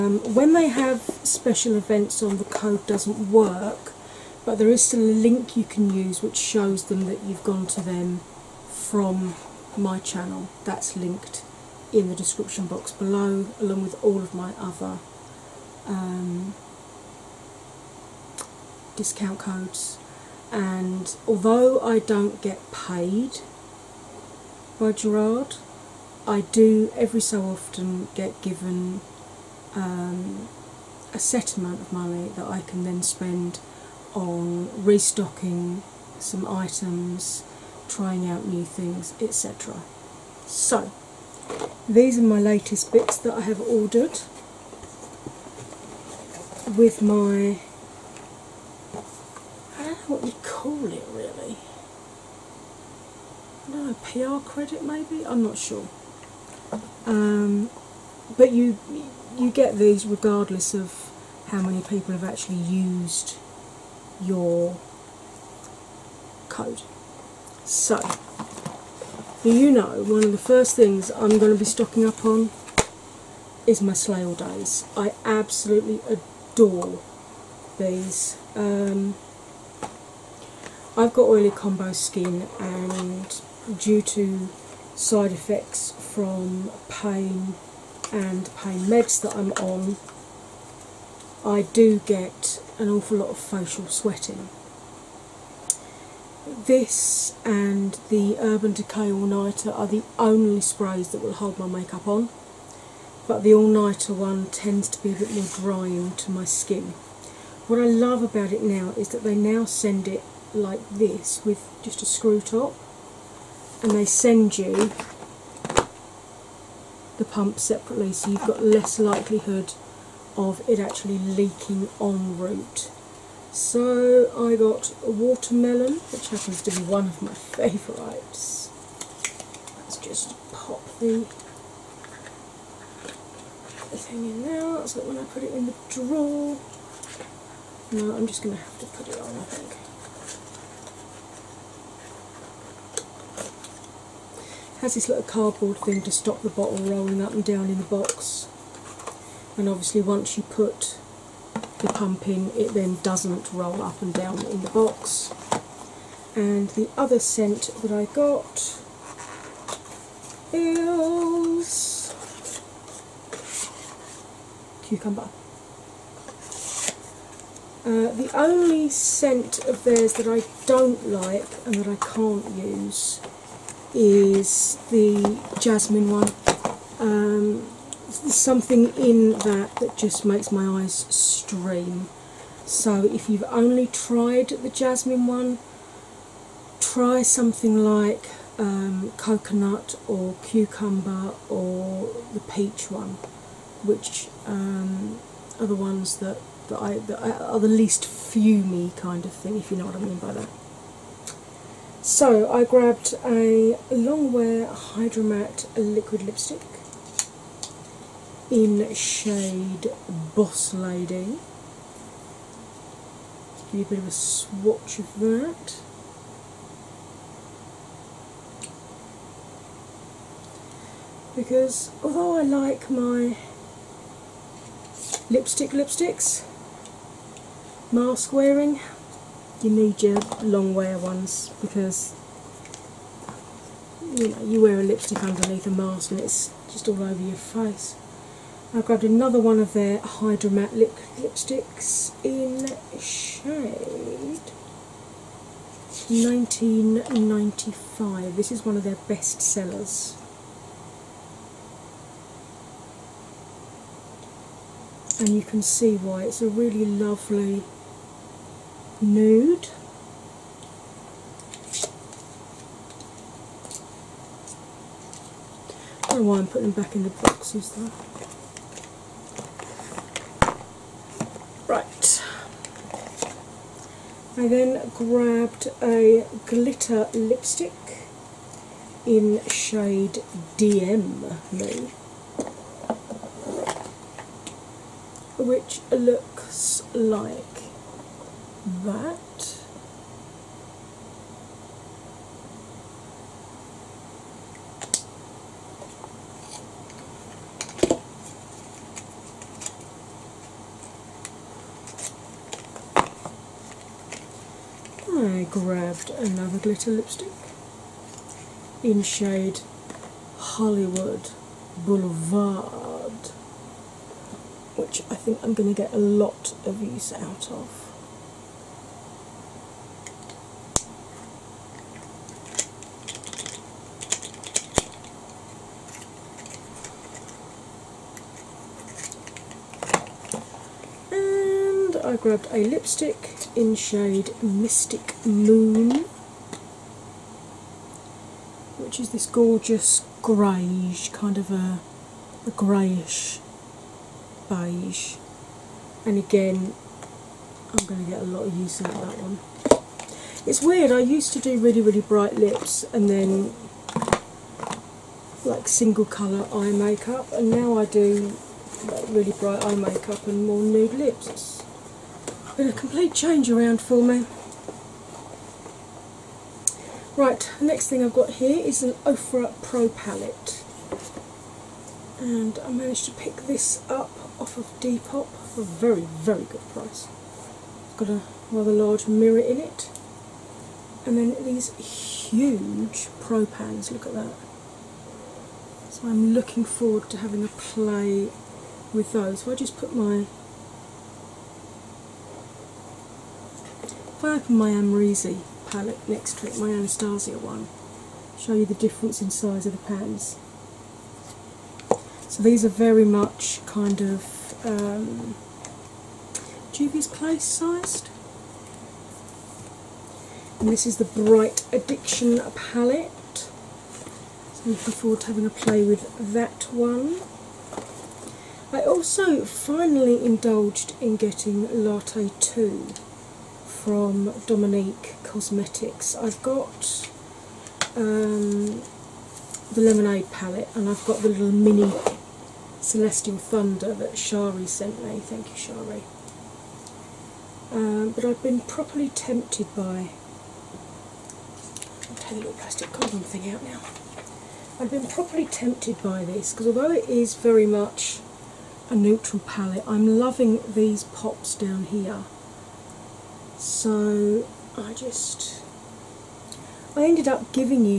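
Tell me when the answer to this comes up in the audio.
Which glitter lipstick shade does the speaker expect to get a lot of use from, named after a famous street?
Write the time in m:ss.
5:10.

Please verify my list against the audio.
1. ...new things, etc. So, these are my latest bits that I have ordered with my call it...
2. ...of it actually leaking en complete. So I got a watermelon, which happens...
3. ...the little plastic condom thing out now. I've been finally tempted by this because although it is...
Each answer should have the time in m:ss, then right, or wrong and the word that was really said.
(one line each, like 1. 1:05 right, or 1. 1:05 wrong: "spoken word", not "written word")
1. 0:38 right
2. 2:00 wrong: "route", not "complete"
3. 7:22 wrong: "properly", not "finally".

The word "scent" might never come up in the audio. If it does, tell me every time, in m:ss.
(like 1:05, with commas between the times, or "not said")
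2:37, 2:48.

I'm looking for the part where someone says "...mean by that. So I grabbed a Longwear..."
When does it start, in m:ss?
3:19.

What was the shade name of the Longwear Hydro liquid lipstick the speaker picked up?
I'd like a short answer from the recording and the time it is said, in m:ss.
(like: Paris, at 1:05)
Boss Lady, at 3:30.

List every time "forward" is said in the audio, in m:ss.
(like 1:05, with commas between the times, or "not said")
6:26, 6:54.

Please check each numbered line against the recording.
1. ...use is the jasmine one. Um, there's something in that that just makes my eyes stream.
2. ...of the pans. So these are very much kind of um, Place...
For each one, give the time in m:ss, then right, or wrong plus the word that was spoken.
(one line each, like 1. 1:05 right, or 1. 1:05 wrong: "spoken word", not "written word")
1. 2:52 right
2. 6:39 right.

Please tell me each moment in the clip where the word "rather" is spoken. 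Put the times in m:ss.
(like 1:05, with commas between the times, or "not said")
6:18.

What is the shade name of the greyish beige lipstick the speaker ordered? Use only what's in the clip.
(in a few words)
Mystic Moon.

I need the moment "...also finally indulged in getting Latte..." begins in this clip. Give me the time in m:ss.
6:58.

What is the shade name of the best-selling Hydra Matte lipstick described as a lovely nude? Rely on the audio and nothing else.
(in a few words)
1995.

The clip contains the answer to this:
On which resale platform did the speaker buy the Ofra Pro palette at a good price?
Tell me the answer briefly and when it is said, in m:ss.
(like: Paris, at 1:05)
Depop, at 6:14.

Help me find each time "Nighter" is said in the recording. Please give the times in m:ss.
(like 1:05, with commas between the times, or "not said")
1:39, 1:43.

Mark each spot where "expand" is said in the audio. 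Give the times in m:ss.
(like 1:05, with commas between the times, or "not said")
not said.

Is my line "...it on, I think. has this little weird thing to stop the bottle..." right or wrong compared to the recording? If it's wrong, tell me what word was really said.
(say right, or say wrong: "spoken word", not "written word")
wrong: "cardboard", not "weird".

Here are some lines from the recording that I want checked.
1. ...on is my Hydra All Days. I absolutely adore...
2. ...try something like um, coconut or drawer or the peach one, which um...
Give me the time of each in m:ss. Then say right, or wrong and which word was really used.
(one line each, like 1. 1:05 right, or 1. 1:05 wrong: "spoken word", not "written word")
1. 1:12 wrong: "Slay", not "Hydra"
2. 3:06 wrong: "cucumber", not "drawer".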